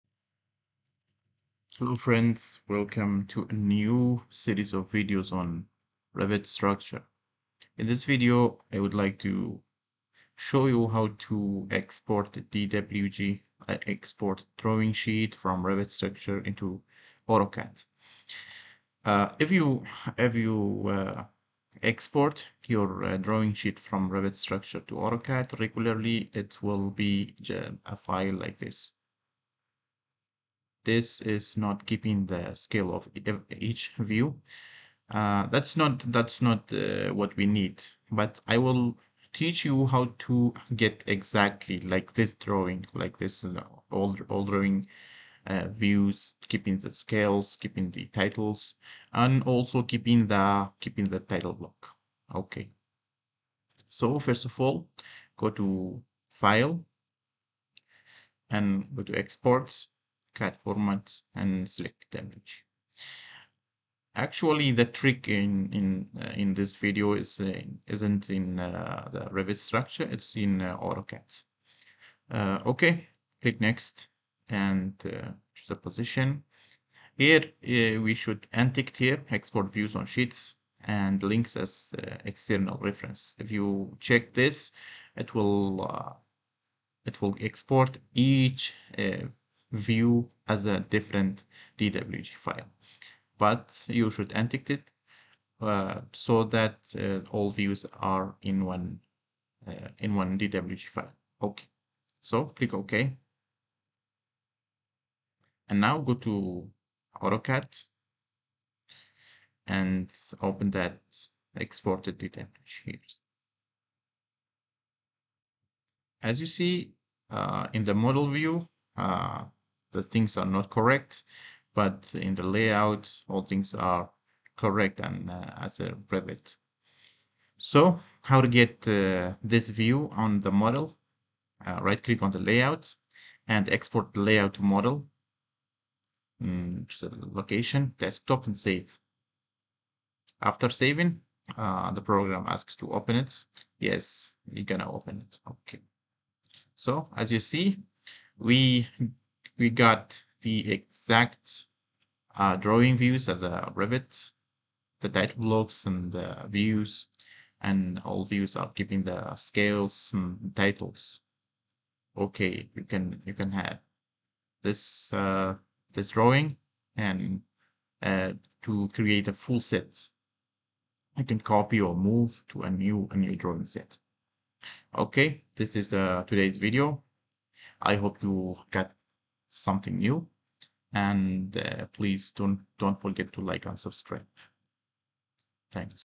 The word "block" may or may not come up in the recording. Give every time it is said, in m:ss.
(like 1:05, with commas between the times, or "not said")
0:51, 2:35.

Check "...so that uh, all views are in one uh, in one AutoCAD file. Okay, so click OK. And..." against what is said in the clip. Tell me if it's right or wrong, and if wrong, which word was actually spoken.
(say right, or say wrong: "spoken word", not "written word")
wrong: "DWG", not "AutoCAD".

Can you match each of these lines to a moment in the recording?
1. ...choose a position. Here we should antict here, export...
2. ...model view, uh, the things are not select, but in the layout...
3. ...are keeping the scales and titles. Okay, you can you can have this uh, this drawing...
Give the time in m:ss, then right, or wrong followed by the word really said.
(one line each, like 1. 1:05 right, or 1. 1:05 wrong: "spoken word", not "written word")
1. 1:15 right
2. 1:57 wrong: "correct", not "select"
3. 2:38 wrong: "giving", not "keeping".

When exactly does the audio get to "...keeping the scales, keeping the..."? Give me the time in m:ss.
0:46.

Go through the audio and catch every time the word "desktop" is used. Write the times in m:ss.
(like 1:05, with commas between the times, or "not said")
2:17.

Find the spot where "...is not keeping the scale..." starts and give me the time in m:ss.
0:31.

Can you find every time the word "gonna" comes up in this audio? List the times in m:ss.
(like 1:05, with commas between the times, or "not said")
2:24.